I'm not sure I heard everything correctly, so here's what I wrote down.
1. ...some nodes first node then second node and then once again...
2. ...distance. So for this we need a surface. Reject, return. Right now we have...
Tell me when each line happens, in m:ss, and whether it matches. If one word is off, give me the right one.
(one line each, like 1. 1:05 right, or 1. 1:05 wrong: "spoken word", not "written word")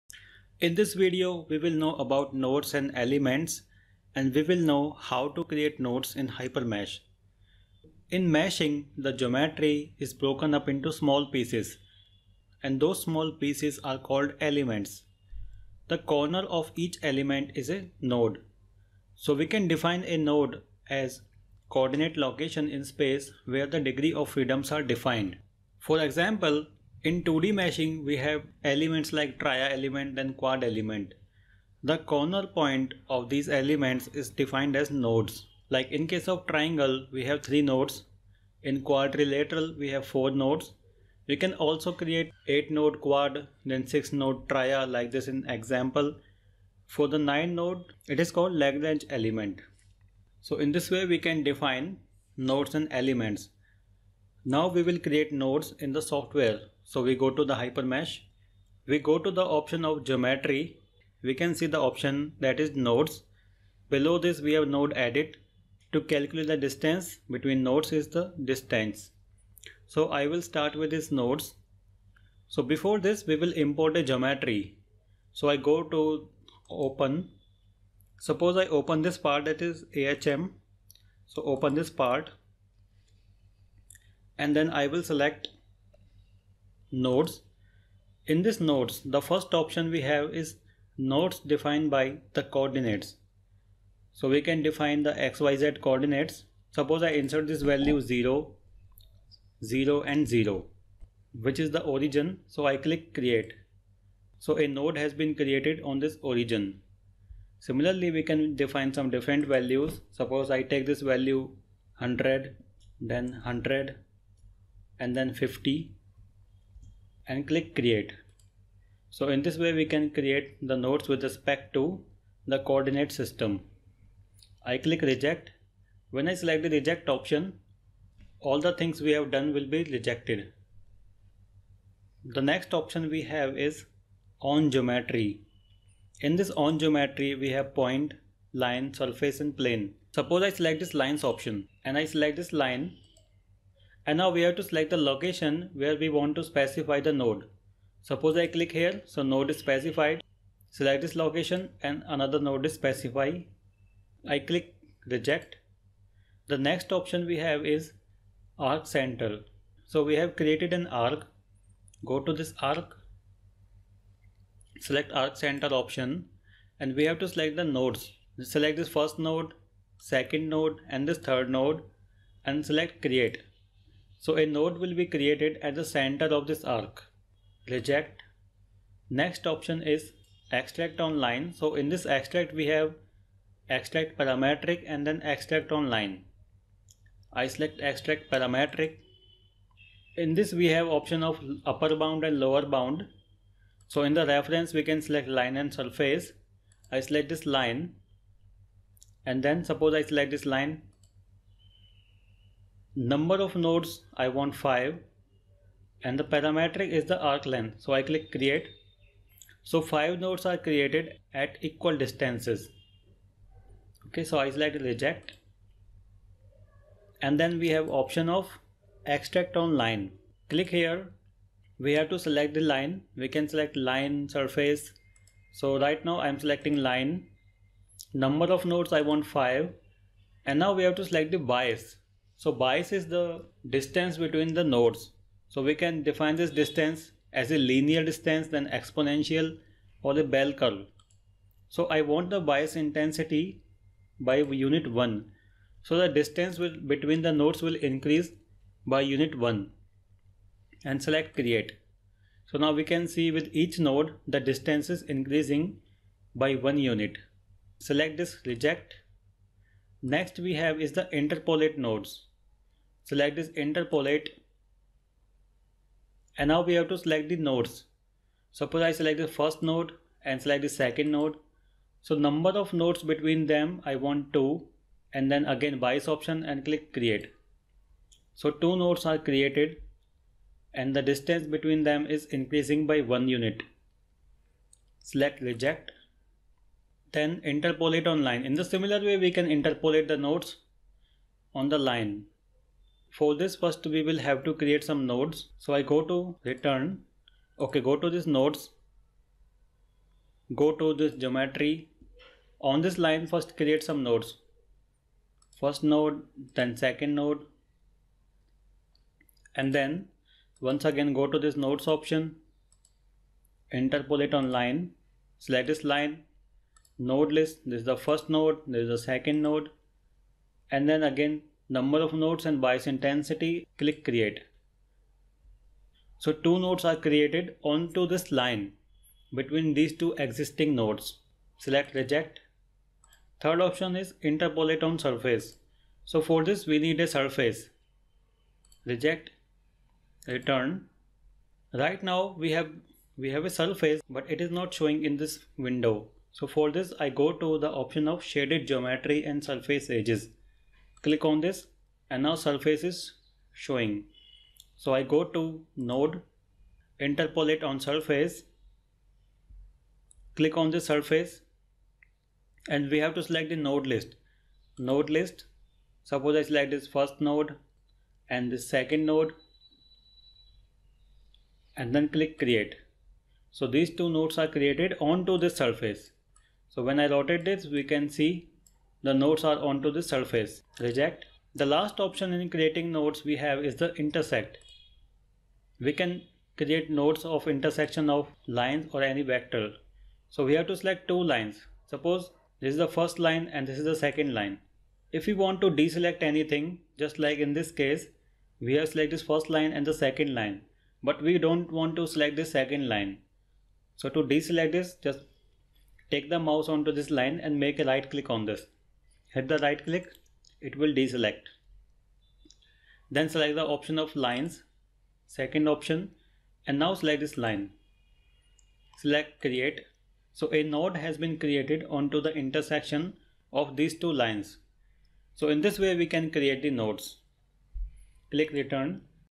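1. 5:03 right
2. 5:34 wrong: "surface", not "distance".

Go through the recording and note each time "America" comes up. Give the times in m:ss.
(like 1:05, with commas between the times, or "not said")
not said.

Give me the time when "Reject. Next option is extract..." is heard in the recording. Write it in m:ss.
2:57.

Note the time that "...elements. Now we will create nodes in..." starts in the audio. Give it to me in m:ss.
0:52.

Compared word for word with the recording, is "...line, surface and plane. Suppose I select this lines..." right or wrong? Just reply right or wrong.
right.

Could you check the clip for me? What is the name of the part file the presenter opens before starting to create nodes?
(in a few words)
AHM.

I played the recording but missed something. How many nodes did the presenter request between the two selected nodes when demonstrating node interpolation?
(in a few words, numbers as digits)
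2.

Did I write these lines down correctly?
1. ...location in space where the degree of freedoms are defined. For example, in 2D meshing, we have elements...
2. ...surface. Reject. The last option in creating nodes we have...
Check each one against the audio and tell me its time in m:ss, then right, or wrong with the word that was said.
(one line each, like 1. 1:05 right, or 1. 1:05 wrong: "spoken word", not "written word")
1. 0:22 right
2. 6:20 right.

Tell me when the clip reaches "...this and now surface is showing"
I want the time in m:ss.
5:51.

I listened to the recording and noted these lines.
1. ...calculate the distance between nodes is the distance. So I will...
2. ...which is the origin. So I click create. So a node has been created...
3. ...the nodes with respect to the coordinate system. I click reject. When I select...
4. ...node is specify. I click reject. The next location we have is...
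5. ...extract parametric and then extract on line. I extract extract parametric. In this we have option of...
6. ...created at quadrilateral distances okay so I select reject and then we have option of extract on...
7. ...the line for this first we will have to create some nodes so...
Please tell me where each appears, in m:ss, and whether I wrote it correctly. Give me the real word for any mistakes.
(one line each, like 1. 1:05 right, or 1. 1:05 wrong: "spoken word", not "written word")
1. 1:06 right
2. 1:41 right
3. 2:00 right
4. 2:32 wrong: "option", not "location"
5. 3:03 wrong: "select", not "extract"
6. 3:30 wrong: "equal", not "quadrilateral"
7. 4:51 right.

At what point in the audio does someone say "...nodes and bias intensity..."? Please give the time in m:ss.
5:22.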